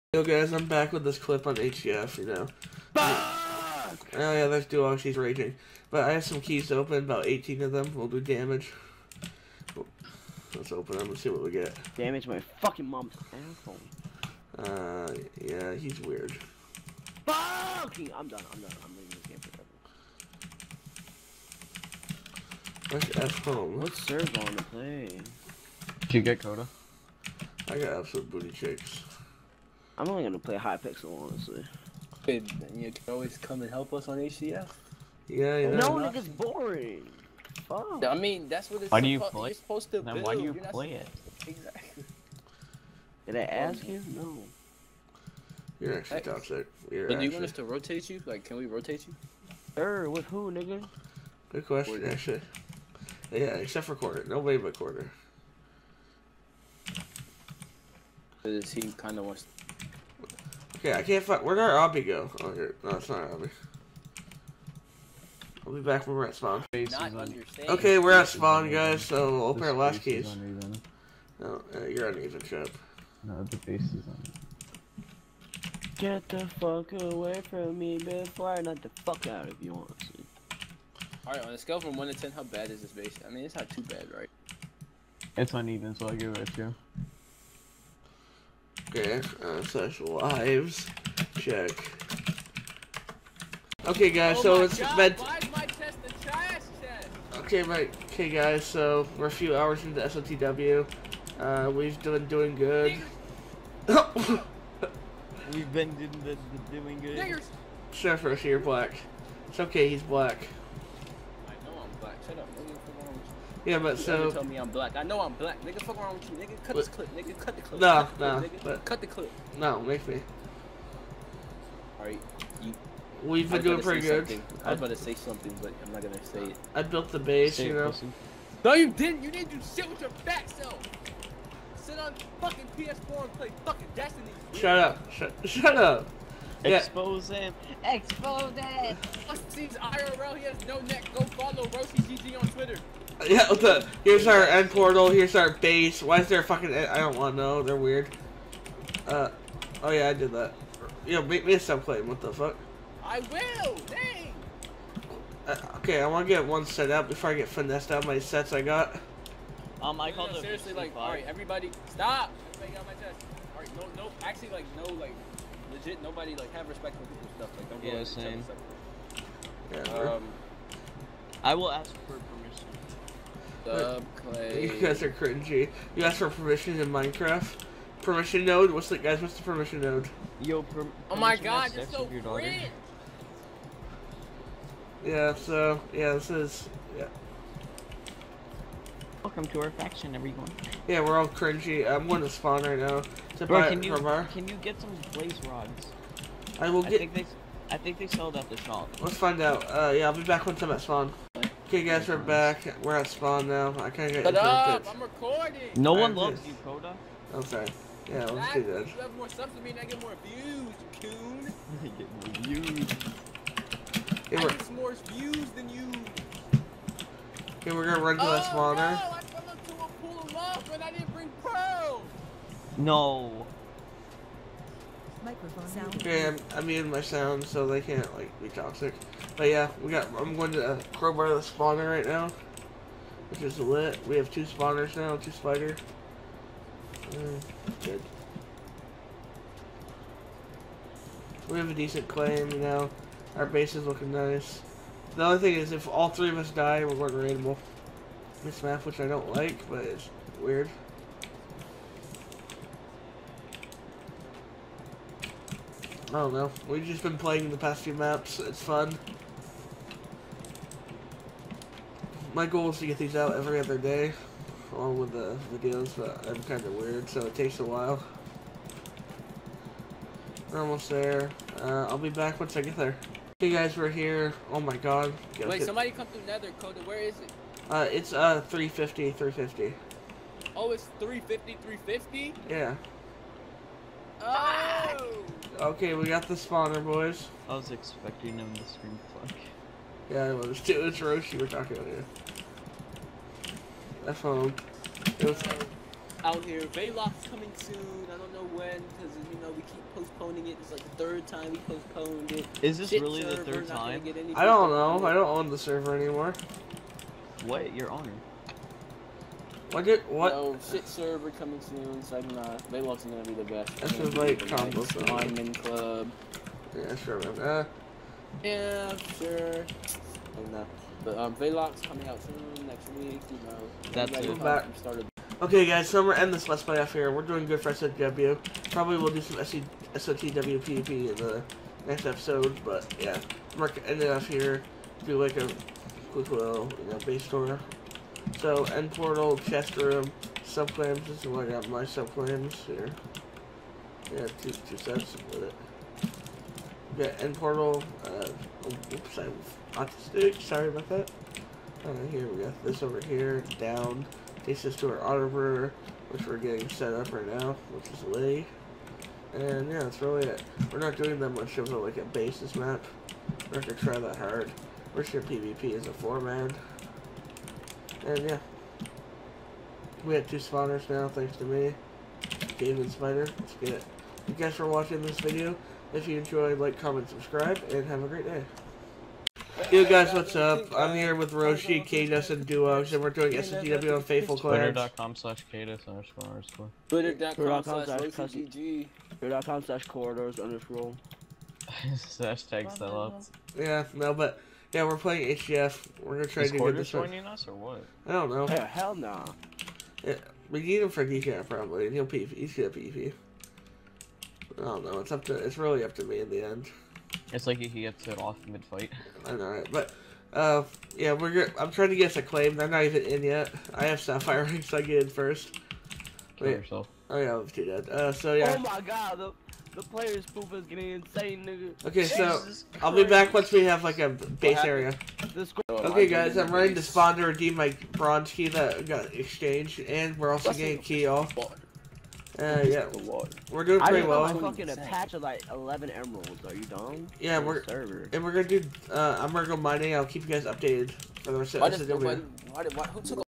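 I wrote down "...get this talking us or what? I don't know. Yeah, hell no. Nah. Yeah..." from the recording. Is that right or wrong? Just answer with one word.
wrong.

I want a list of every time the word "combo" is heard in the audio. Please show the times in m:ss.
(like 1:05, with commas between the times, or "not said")
5:14.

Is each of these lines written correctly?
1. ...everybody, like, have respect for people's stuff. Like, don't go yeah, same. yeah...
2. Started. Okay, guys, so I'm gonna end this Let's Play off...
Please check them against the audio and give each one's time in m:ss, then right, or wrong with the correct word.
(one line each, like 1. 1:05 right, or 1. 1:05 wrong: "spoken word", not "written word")
1. 2:46 wrong: "nobody", not "everybody"
2. 5:24 right.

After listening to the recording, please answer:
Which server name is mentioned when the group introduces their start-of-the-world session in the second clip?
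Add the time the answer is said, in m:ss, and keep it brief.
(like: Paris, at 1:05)
Faithful Clans, at 6:24.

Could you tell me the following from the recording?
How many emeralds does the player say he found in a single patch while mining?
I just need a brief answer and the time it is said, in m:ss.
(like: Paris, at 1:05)
11, at 7:15.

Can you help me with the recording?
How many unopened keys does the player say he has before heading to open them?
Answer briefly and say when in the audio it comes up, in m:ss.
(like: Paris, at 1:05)
18, at 0:07.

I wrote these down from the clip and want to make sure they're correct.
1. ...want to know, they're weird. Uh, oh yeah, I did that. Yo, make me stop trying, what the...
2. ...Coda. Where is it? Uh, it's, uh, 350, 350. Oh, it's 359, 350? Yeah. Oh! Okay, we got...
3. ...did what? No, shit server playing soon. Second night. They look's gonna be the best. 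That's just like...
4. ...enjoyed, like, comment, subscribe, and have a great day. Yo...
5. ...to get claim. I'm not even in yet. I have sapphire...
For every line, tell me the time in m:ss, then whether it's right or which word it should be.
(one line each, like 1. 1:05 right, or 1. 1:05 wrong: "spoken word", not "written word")
1. 2:27 wrong: "playing", not "trying"
2. 4:36 wrong: "350", not "359"
3. 5:09 wrong: "coming", not "playing"
4. 6:16 right
5. 6:51 right.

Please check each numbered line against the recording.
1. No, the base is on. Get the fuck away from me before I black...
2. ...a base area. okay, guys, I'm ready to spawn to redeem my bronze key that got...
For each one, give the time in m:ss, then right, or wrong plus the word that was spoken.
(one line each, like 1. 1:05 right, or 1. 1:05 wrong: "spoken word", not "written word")
1. 1:13 wrong: "knock", not "black"
2. 7:03 right.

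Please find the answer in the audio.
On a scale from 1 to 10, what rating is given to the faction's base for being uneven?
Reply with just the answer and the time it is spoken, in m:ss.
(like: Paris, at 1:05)
2, at 1:26.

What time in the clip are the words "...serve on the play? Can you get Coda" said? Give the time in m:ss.
0:24.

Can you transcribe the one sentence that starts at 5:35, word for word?
Do like a quick little you know, base store so, end portal, chest room, subclaims.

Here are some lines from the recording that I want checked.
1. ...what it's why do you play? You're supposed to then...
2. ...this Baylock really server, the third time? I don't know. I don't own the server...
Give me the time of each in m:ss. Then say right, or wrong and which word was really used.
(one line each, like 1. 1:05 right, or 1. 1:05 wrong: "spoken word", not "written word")
1. 0:38 right
2. 5:02 wrong: "Shit", not "Baylock".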